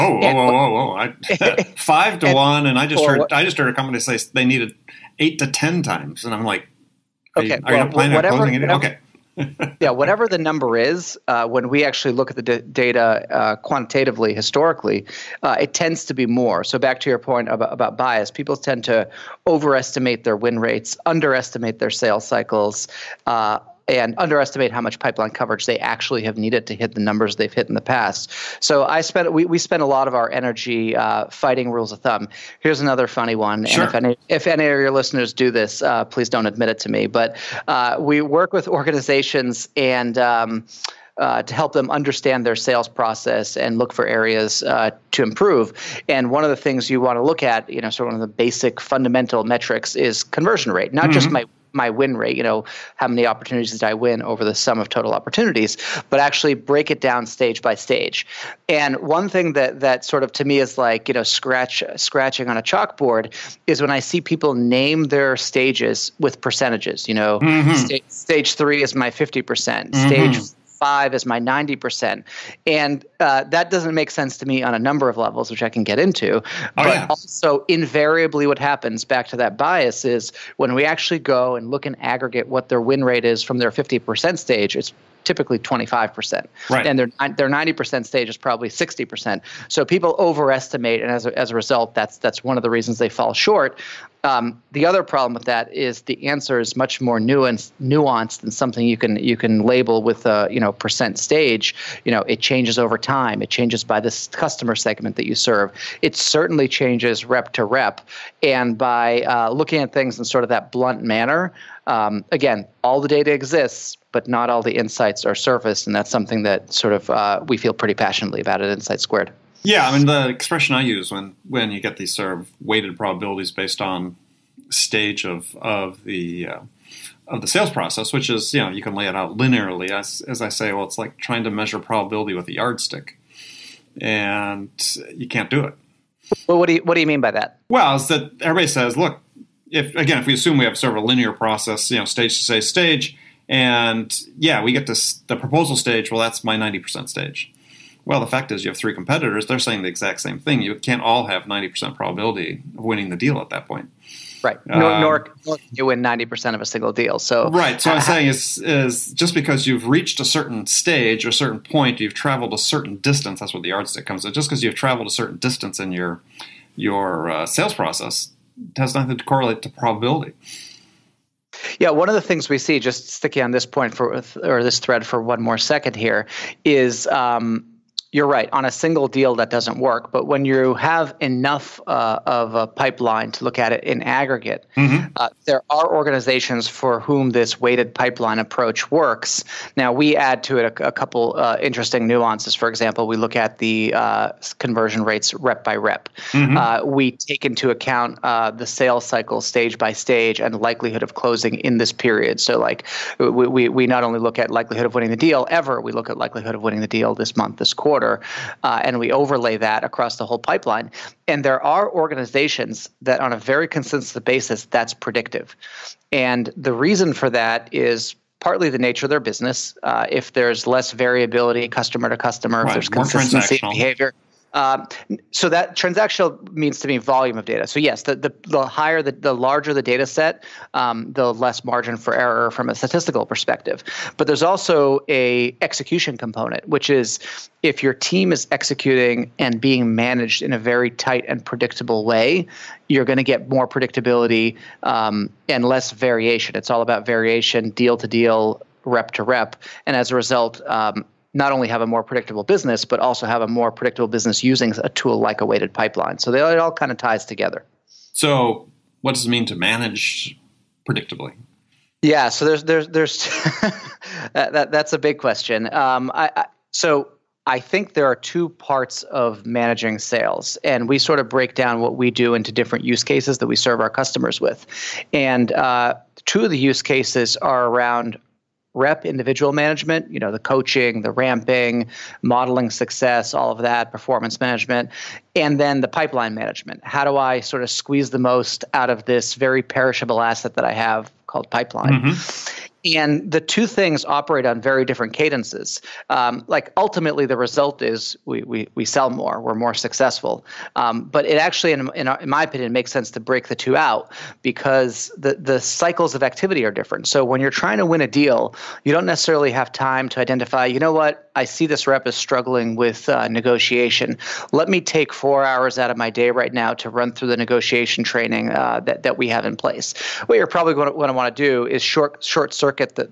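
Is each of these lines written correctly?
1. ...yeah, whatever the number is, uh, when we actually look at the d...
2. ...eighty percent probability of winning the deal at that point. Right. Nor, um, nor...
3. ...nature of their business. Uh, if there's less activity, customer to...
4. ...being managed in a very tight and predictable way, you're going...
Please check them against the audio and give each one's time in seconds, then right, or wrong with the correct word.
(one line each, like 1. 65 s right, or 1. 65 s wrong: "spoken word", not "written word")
1. 9 s right
2. 151 s wrong: "ninety", not "eighty"
3. 218 s wrong: "variability", not "activity"
4. 239 s right.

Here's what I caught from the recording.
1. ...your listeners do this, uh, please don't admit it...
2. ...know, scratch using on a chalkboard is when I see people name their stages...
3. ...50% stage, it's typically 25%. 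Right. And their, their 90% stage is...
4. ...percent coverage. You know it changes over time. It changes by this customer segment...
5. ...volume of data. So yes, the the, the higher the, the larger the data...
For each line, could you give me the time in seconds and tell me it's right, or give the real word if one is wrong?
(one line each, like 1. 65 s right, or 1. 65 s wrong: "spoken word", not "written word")
1. 34 s right
2. 61 s wrong: "scratching", not "using"
3. 83 s right
4. 100 s wrong: "stage", not "coverage"
5. 226 s right.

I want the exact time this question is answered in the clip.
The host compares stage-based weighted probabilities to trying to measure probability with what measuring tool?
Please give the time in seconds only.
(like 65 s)
132 s.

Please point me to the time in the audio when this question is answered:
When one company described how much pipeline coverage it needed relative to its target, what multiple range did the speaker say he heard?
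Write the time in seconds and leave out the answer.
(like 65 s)
5 s.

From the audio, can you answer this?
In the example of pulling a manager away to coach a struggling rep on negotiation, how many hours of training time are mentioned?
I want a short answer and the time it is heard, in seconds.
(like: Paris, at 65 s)
4 hours, at 315 s.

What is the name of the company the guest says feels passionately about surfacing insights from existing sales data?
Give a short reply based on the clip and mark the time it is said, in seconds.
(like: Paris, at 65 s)
Insight Squared, at 118 s.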